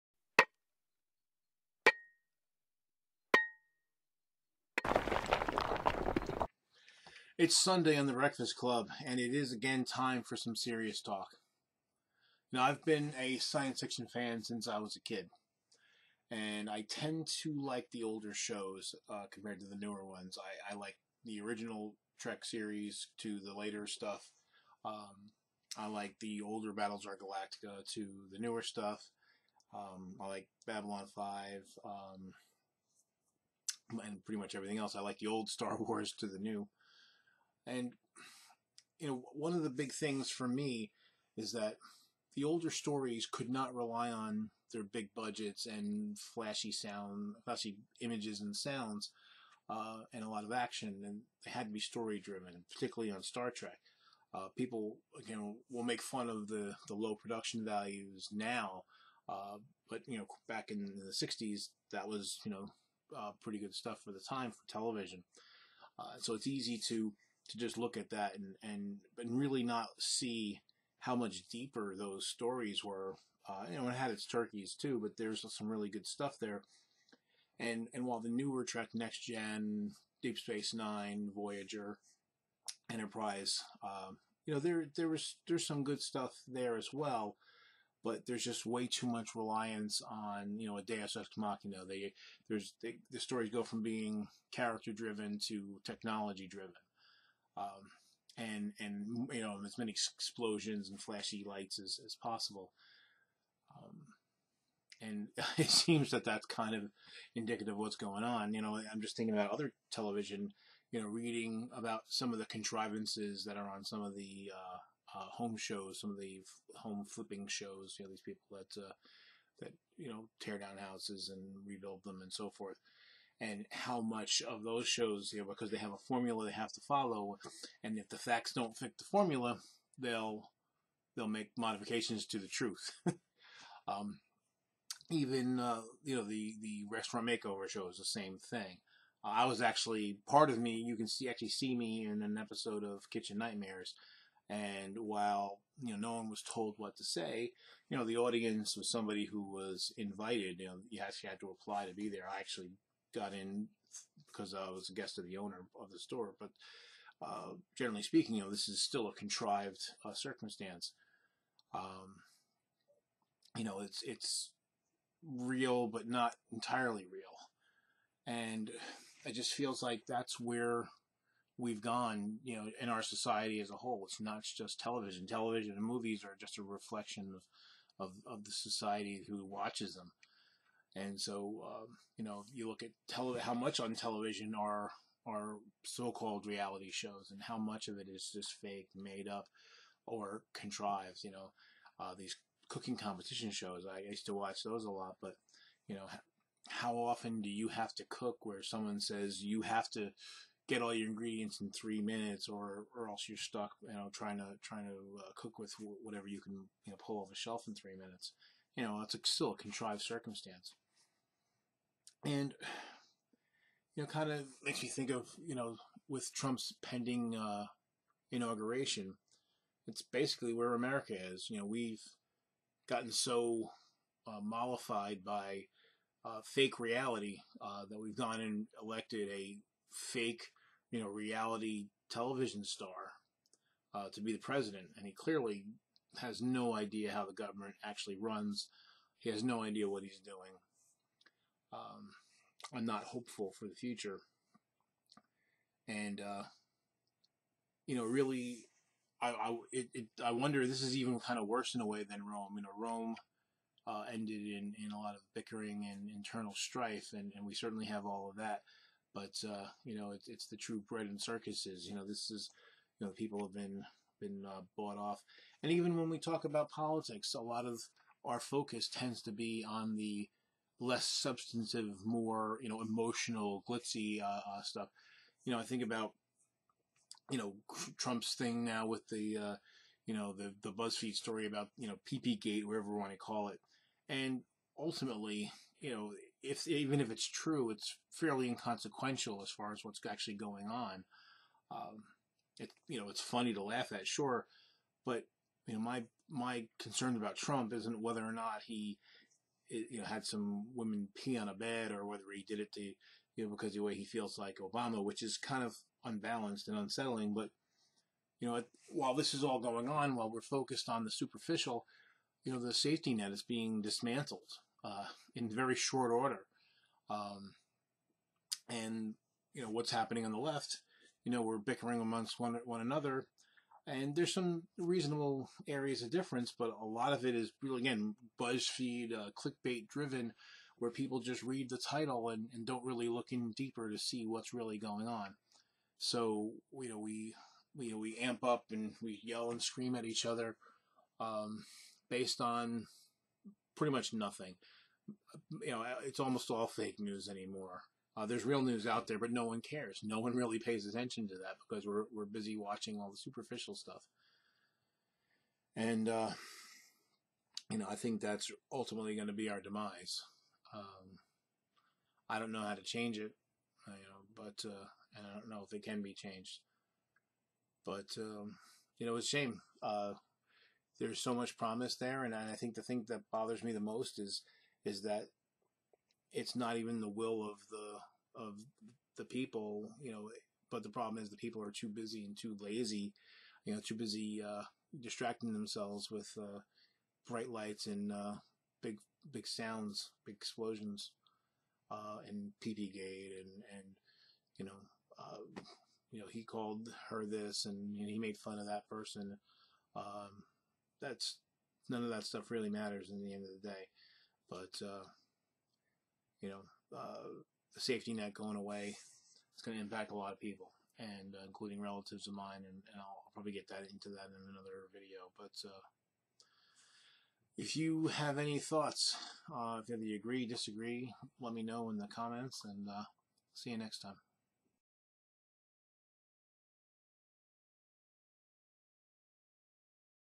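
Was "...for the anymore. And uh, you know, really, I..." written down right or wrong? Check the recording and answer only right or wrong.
wrong.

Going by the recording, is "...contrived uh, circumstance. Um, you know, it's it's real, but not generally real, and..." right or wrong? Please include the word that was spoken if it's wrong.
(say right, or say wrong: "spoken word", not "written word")
wrong: "entirely", not "generally".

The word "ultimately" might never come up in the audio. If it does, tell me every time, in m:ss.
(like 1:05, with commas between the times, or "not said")
4:44, 5:58.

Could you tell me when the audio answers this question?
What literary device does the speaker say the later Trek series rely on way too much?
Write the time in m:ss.
1:30.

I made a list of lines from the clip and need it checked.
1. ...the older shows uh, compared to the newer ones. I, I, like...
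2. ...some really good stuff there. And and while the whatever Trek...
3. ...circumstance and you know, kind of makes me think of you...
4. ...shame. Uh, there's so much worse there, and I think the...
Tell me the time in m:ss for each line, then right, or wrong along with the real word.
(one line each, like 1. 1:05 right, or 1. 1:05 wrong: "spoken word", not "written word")
1. 0:17 right
2. 1:15 wrong: "newer", not "whatever"
3. 3:30 right
4. 6:09 wrong: "promise", not "worse".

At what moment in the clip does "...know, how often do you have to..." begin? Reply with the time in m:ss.
3:15.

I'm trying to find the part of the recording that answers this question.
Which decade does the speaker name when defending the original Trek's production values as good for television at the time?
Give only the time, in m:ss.
1:01.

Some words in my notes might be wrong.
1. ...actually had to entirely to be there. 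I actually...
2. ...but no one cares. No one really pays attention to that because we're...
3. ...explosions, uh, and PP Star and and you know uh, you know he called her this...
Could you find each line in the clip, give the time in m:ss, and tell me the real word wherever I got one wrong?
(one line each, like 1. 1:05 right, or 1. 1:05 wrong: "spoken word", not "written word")
1. 2:31 wrong: "apply", not "entirely"
2. 5:49 right
3. 6:30 wrong: "Gate", not "Star".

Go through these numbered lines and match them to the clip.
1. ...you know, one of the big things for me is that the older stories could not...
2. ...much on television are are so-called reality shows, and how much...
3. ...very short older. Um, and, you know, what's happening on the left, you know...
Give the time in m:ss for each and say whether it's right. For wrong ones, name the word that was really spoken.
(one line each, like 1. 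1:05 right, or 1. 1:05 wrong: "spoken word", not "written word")
1. 0:38 right
2. 3:03 right
3. 5:15 wrong: "order", not "older".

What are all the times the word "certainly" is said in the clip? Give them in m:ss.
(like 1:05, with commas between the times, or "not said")
4:17.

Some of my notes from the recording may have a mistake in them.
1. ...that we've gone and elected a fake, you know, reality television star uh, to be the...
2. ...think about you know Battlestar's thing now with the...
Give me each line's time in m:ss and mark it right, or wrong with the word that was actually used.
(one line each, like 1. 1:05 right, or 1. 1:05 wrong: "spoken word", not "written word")
1. 3:47 right
2. 4:35 wrong: "Trump", not "Battlestar".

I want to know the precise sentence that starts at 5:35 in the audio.
So, you know, we, we, we amp up and we yell and scream at each other um, based on pretty much nothing.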